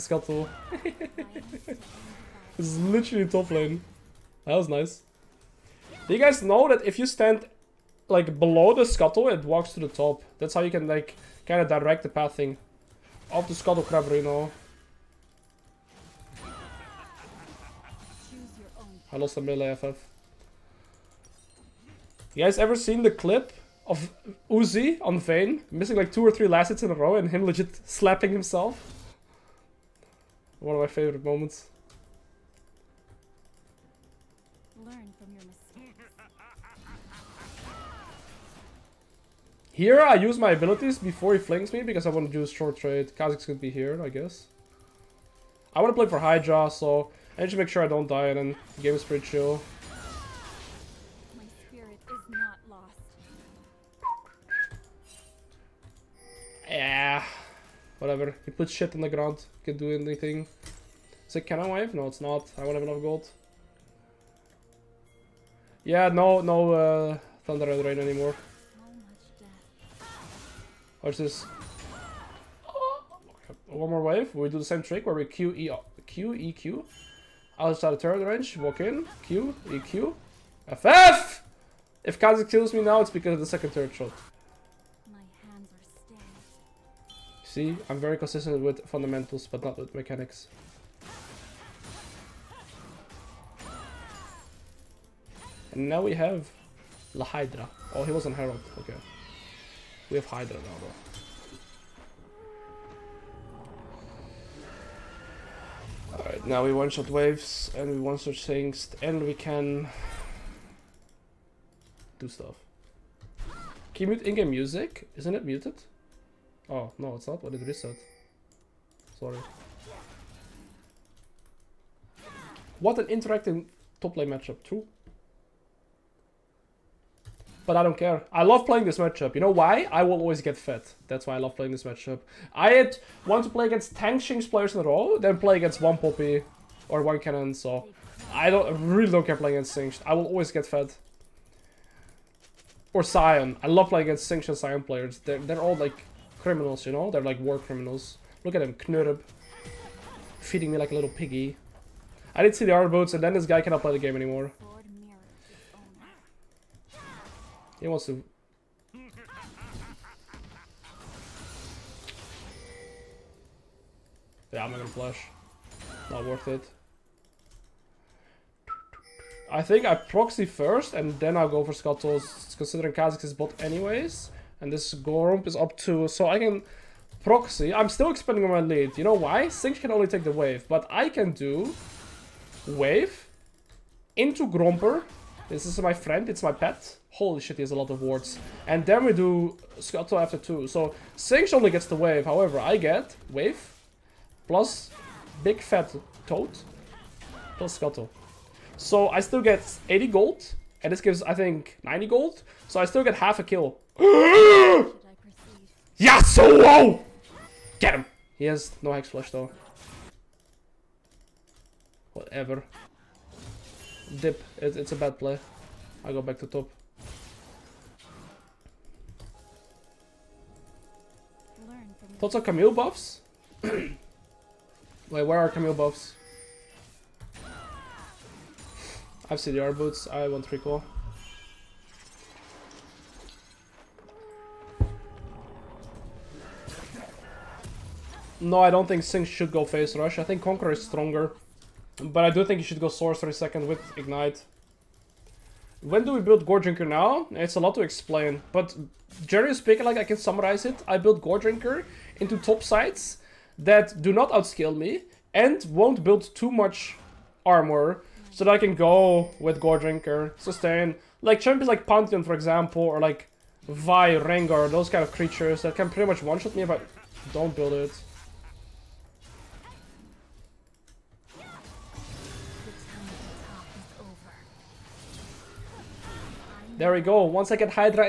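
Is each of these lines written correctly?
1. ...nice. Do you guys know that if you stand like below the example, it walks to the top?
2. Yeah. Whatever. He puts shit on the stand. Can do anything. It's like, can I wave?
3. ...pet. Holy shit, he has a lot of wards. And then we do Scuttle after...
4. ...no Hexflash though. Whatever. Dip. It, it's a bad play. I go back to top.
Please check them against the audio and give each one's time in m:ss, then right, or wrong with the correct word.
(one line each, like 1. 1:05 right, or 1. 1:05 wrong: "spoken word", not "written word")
1. 0:04 wrong: "scuttle", not "example"
2. 0:56 wrong: "ground", not "stand"
3. 3:06 right
4. 3:28 right.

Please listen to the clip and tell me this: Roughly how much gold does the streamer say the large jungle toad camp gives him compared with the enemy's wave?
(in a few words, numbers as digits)
80.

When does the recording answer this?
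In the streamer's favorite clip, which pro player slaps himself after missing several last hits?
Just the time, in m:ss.
0:24.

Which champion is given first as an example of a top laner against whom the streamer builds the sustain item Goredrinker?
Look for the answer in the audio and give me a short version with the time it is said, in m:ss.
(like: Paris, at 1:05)
Pantheon, at 4:21.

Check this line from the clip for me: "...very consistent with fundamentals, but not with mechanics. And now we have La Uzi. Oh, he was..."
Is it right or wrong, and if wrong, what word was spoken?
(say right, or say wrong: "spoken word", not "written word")
wrong: "Hydra", not "Uzi".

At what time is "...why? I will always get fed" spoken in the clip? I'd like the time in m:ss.
2:09.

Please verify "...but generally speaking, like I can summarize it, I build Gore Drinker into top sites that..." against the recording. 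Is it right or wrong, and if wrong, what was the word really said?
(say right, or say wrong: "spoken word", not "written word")
right.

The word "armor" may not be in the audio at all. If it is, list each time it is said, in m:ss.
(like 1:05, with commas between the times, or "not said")
2:32, 4:17.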